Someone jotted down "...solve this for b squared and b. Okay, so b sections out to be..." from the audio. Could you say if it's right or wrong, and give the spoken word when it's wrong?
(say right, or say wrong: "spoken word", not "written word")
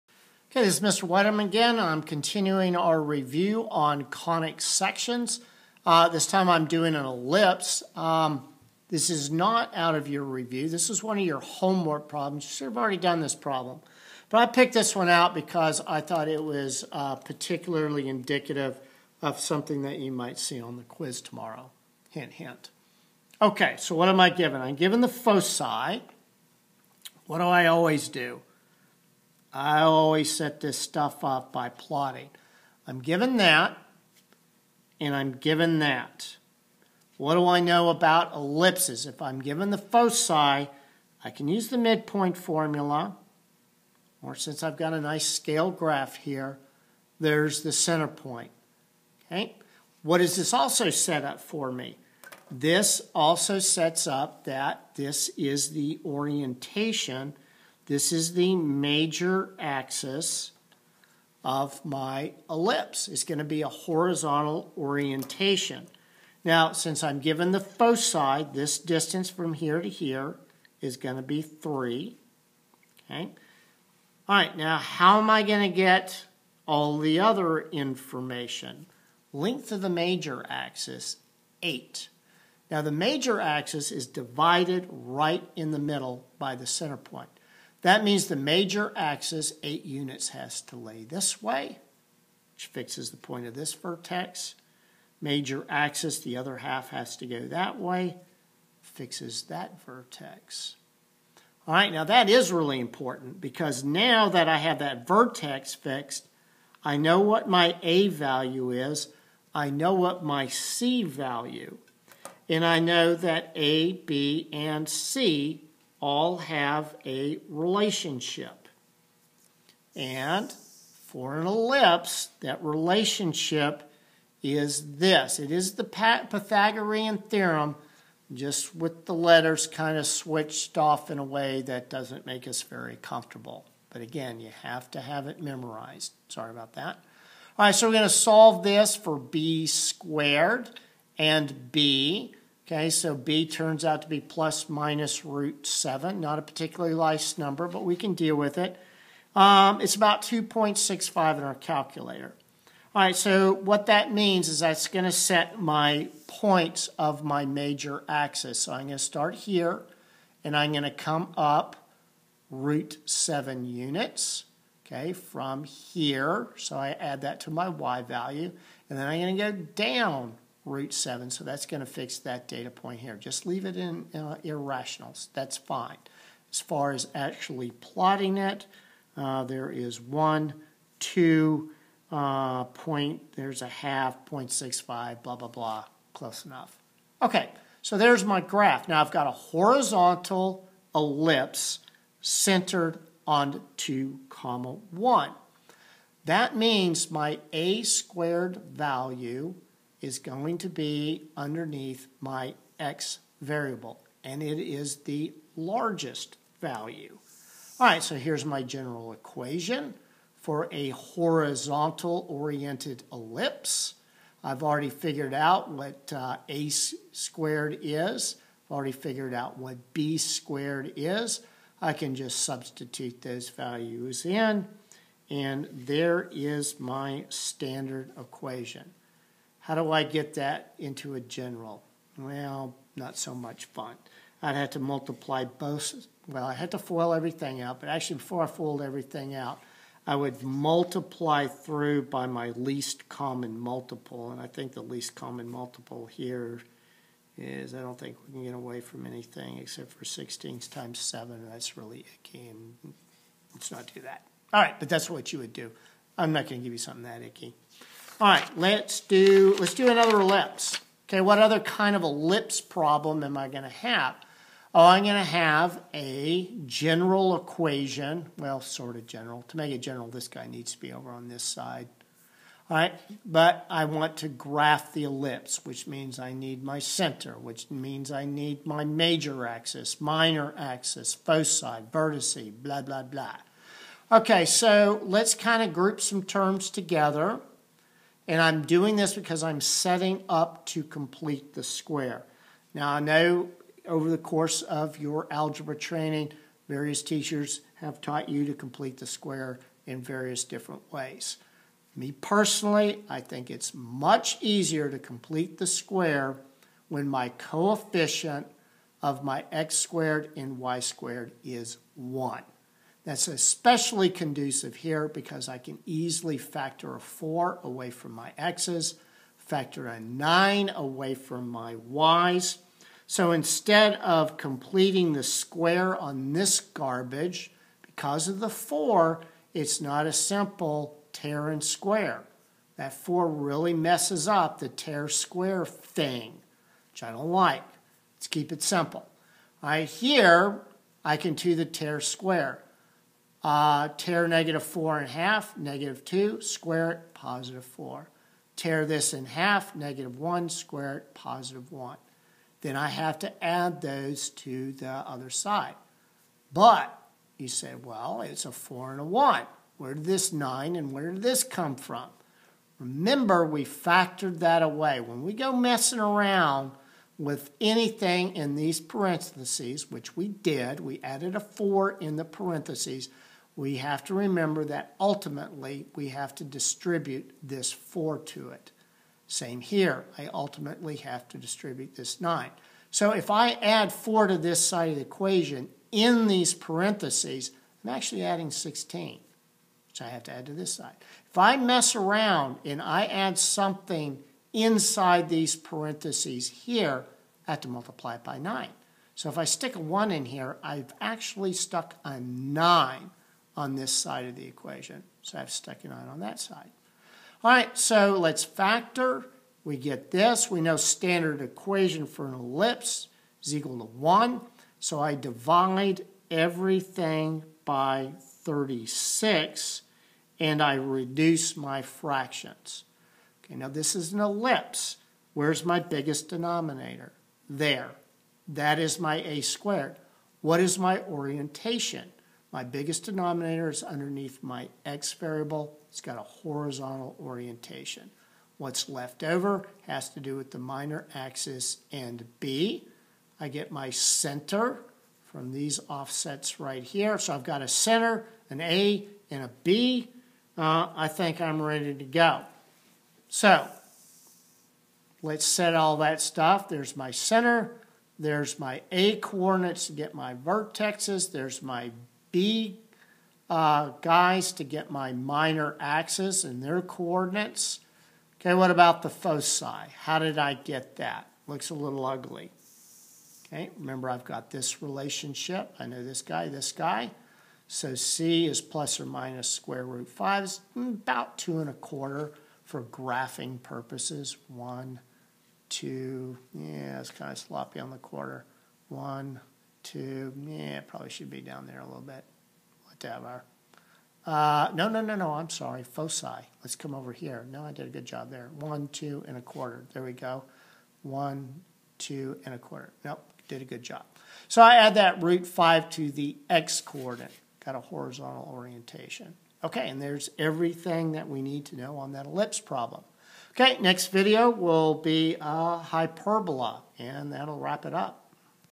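wrong: "turns", not "sections".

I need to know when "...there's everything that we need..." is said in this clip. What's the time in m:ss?
8:30.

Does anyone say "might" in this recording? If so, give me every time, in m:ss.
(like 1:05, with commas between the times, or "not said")
0:20.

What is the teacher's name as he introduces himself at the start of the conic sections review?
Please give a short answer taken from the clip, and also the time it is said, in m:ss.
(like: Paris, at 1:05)
Mr. Weideman, at 0:00.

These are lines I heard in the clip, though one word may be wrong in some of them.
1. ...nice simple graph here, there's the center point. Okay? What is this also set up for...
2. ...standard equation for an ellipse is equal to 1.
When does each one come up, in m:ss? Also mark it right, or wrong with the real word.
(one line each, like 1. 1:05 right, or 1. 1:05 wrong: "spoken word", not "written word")
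1. 0:45 wrong: "scale", not "simple"
2. 6:50 right.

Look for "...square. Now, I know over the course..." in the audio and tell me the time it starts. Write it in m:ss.
4:51.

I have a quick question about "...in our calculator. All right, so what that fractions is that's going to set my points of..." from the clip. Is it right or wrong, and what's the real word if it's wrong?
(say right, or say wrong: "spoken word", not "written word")
wrong: "means", not "fractions".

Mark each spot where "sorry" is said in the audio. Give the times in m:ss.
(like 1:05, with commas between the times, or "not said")
2:16, 8:15.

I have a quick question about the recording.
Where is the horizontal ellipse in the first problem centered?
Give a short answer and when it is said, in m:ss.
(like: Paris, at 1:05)
2, 1, at 3:13.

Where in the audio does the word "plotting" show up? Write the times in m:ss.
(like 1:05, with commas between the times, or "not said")
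0:31, 2:57.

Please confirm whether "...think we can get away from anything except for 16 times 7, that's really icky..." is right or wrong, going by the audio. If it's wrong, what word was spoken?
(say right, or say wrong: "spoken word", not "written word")
right.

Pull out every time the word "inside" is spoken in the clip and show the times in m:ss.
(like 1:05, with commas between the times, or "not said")
6:34.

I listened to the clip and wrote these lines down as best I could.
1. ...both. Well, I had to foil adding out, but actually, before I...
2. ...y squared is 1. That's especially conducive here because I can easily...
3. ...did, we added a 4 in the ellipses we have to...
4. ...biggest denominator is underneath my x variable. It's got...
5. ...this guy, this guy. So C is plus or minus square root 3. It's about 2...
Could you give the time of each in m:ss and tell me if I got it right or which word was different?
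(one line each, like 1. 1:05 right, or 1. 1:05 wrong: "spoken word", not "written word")
1. 3:55 wrong: "everything", not "adding"
2. 5:10 right
3. 6:10 wrong: "parentheses", not "ellipses"
4. 7:12 right
5. 7:56 wrong: "5", not "3".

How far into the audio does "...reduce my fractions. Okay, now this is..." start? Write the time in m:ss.
7:00.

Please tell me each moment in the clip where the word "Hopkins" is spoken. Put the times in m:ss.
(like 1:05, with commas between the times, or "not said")
not said.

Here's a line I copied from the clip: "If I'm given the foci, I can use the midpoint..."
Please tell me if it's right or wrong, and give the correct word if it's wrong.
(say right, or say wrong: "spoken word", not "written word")
right.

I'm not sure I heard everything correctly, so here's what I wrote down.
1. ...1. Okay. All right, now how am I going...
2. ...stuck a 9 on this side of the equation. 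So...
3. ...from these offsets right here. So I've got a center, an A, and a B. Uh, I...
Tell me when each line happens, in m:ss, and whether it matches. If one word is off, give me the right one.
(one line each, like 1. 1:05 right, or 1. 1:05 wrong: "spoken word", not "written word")
1. 1:11 wrong: "3", not "1"
2. 6:41 right
3. 7:25 right.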